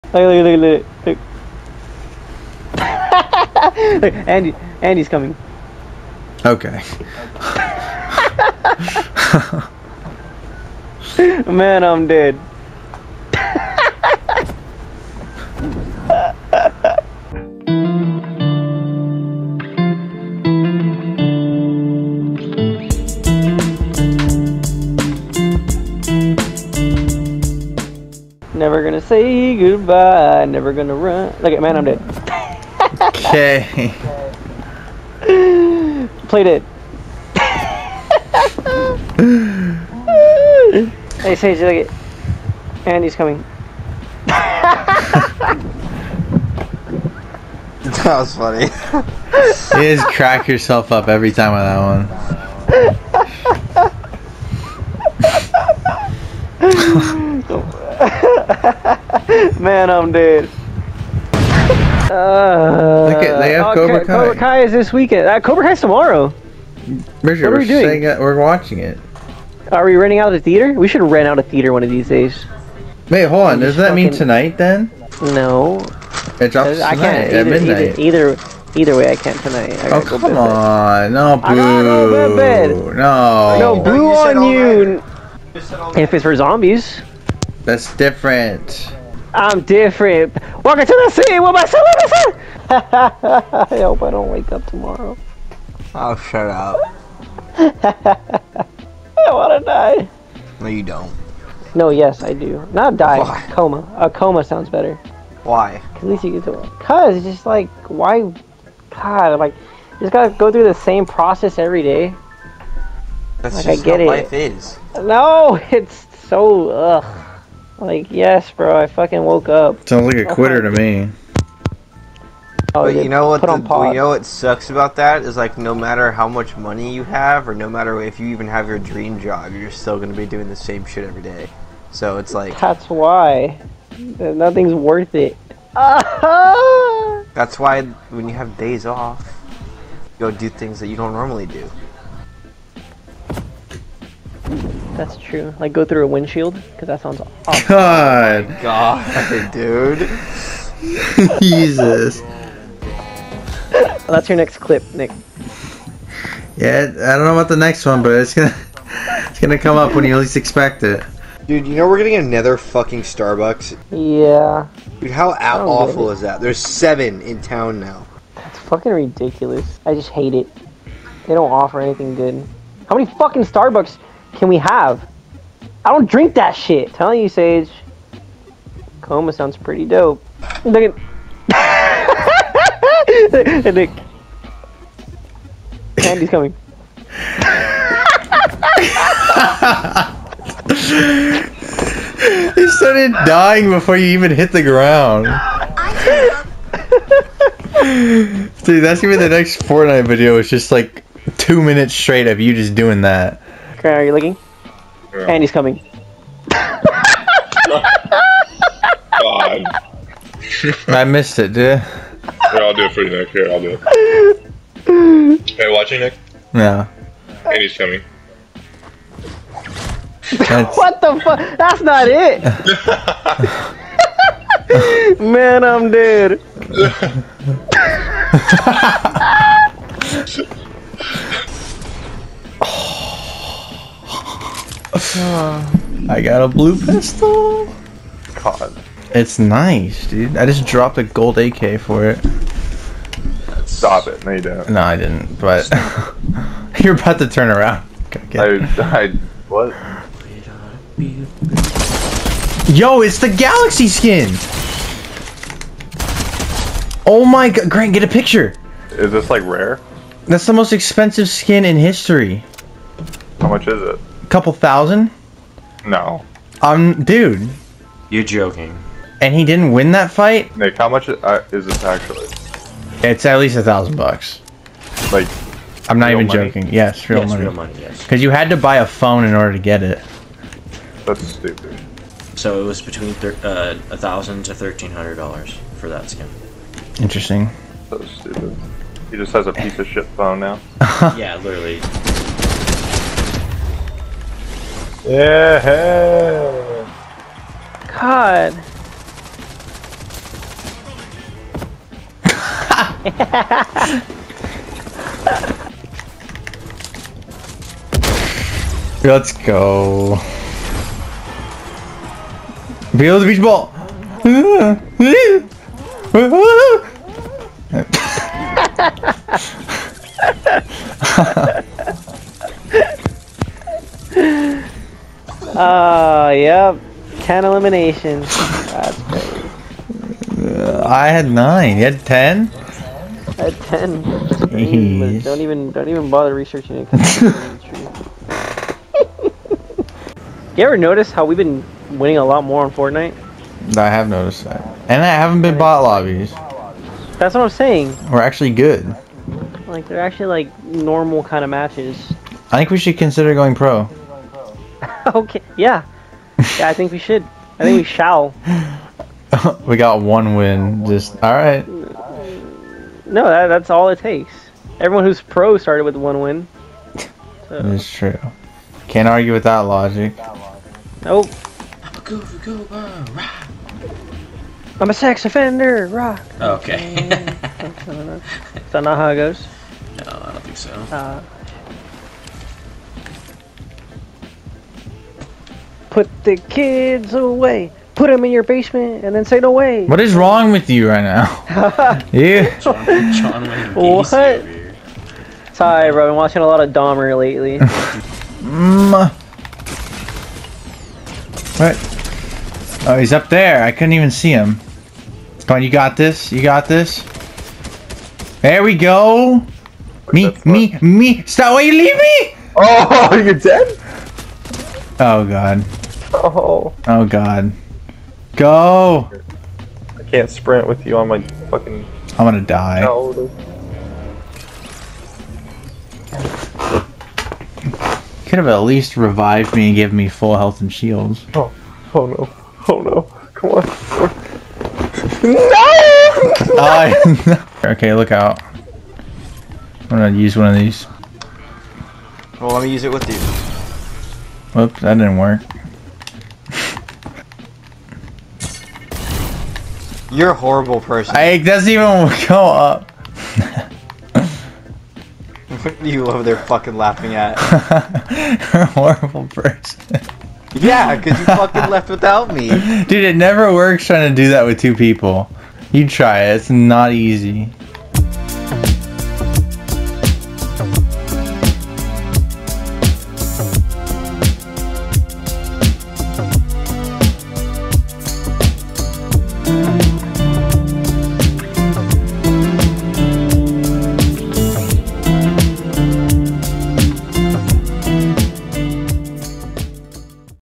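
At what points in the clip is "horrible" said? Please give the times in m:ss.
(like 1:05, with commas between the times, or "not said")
7:30, 7:38.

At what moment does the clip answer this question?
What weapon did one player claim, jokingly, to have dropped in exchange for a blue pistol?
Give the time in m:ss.
4:01.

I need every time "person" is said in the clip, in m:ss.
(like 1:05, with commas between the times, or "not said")
7:30, 7:39.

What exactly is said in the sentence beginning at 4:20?
That's the most expensive skin in history.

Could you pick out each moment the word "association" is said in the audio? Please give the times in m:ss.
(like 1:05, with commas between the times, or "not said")
not said.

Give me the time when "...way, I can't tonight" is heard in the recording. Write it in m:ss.
1:18.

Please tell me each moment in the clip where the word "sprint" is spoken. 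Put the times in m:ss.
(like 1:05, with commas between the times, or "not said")
7:00.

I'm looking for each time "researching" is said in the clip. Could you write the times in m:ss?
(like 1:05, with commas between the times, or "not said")
5:36.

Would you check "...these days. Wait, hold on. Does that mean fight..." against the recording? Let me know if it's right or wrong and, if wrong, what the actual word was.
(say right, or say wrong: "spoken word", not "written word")
wrong: "tonight", not "fight".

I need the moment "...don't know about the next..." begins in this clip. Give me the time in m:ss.
2:37.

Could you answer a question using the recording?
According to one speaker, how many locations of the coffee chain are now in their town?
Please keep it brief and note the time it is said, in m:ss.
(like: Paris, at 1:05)
7, at 2:46.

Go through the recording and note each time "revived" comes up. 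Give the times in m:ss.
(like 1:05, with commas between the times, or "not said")
7:08.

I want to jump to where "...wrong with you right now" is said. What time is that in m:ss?
6:30.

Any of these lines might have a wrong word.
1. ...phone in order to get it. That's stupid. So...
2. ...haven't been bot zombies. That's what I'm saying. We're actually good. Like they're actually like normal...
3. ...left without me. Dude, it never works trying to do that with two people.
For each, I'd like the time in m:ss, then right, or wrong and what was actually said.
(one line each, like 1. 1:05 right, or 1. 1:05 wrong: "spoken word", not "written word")
1. 4:38 right
2. 5:45 wrong: "lobbies", not "zombies"
3. 7:41 right.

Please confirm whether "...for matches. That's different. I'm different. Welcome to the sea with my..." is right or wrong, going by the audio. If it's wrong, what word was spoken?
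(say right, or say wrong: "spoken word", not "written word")
wrong: "zombies", not "matches".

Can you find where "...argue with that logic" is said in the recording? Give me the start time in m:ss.
6:09.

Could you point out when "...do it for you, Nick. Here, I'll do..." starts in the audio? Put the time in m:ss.
3:32.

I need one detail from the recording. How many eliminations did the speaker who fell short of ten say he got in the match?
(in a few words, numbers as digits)
9.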